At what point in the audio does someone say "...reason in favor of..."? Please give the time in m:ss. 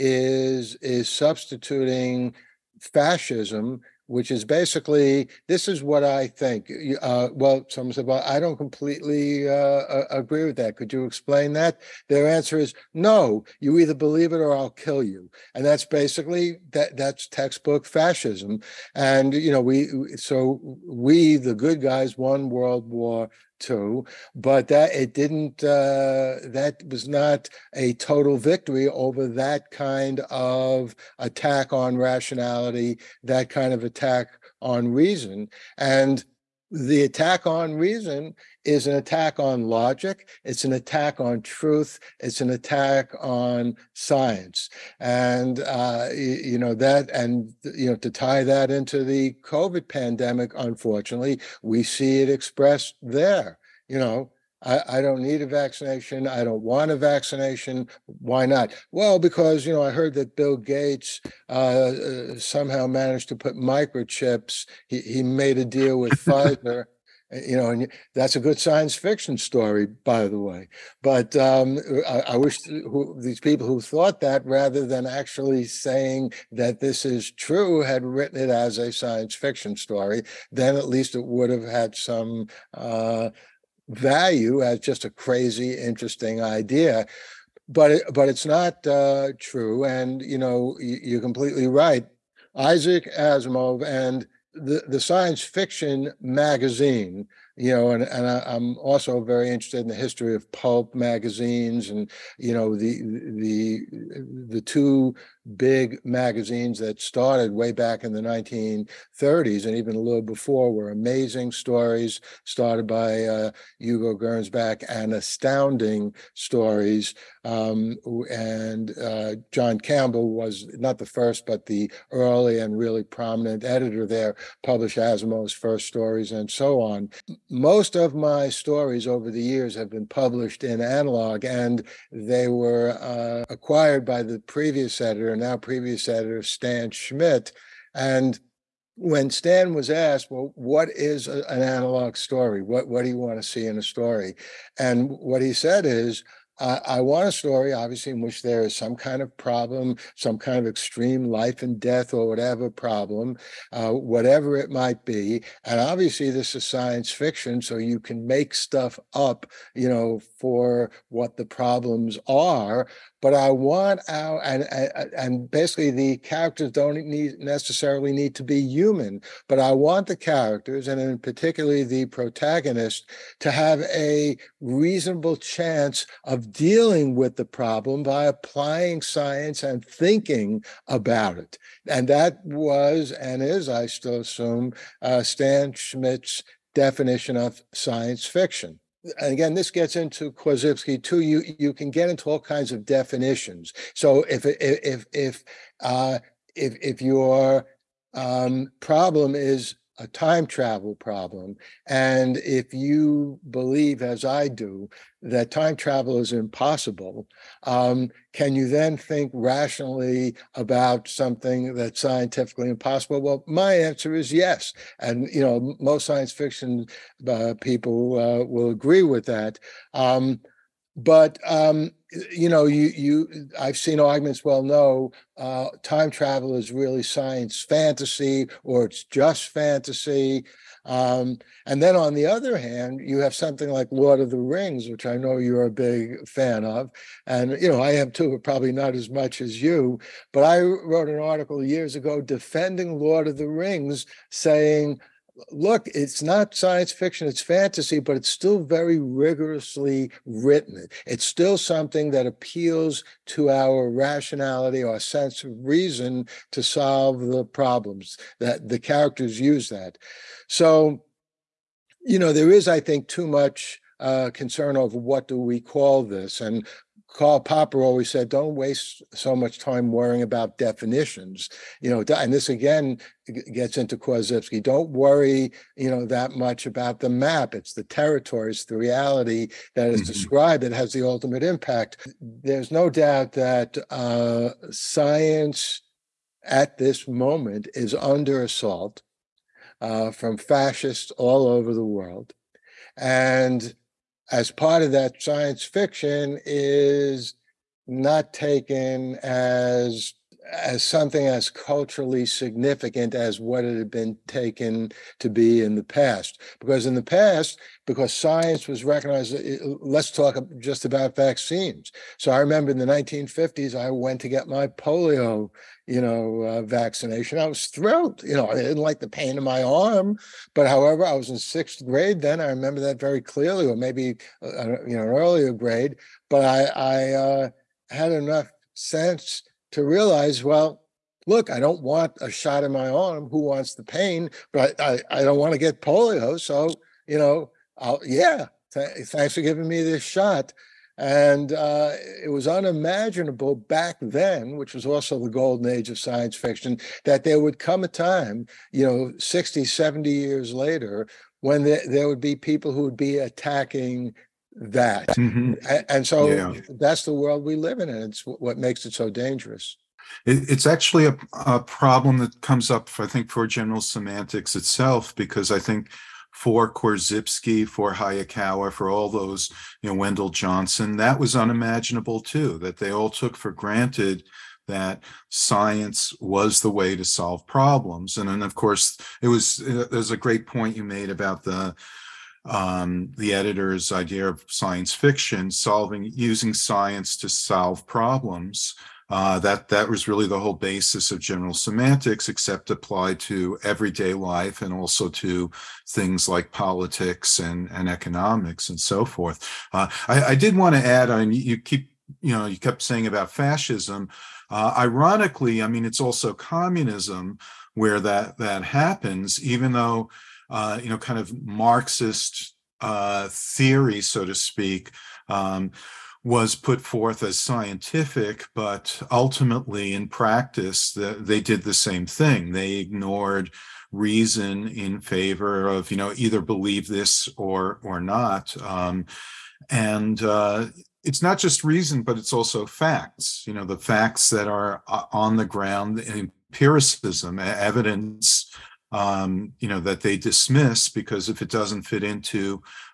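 7:03.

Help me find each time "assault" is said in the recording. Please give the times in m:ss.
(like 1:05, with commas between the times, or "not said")
4:48.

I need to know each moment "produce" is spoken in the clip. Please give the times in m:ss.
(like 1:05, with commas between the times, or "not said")
not said.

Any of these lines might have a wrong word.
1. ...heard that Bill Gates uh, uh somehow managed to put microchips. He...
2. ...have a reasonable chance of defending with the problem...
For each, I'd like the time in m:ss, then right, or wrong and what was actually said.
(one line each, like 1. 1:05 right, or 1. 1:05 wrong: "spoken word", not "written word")
1. 0:59 right
2. 2:53 wrong: "dealing", not "defending".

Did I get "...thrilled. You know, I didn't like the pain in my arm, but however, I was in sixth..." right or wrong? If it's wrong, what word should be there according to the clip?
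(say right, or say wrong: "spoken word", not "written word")
right.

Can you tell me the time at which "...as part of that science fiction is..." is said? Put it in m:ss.
4:54.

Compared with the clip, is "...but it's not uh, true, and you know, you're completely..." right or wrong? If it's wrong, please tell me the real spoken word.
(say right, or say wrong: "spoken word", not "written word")
right.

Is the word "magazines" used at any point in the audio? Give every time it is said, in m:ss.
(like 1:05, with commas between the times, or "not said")
1:36, 1:40, 1:46.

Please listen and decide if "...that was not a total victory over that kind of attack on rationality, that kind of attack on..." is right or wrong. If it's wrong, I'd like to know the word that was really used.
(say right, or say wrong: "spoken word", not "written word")
right.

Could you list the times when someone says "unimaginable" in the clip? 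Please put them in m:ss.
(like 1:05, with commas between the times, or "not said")
5:42, 6:11.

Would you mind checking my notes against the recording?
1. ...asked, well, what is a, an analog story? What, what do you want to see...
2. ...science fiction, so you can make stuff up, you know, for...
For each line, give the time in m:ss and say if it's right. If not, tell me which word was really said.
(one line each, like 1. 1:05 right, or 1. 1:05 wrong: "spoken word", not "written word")
1. 2:19 right
2. 2:36 right.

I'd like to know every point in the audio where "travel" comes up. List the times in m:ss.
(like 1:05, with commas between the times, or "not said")
3:20, 3:25, 3:46.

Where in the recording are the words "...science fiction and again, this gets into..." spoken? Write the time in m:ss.
3:07.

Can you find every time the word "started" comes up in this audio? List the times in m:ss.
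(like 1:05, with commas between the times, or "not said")
1:46, 1:52.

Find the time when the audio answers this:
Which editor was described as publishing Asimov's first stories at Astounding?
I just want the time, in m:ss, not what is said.
1:59.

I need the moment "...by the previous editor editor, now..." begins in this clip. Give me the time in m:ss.
2:14.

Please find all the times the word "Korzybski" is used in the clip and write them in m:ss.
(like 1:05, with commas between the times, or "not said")
3:10, 4:33, 6:06.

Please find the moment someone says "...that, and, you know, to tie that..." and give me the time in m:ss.
0:46.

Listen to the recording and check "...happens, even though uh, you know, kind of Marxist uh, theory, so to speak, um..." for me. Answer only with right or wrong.
right.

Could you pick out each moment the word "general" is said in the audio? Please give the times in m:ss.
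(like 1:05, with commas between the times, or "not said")
6:03, 6:31.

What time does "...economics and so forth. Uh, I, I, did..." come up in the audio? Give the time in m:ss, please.
6:37.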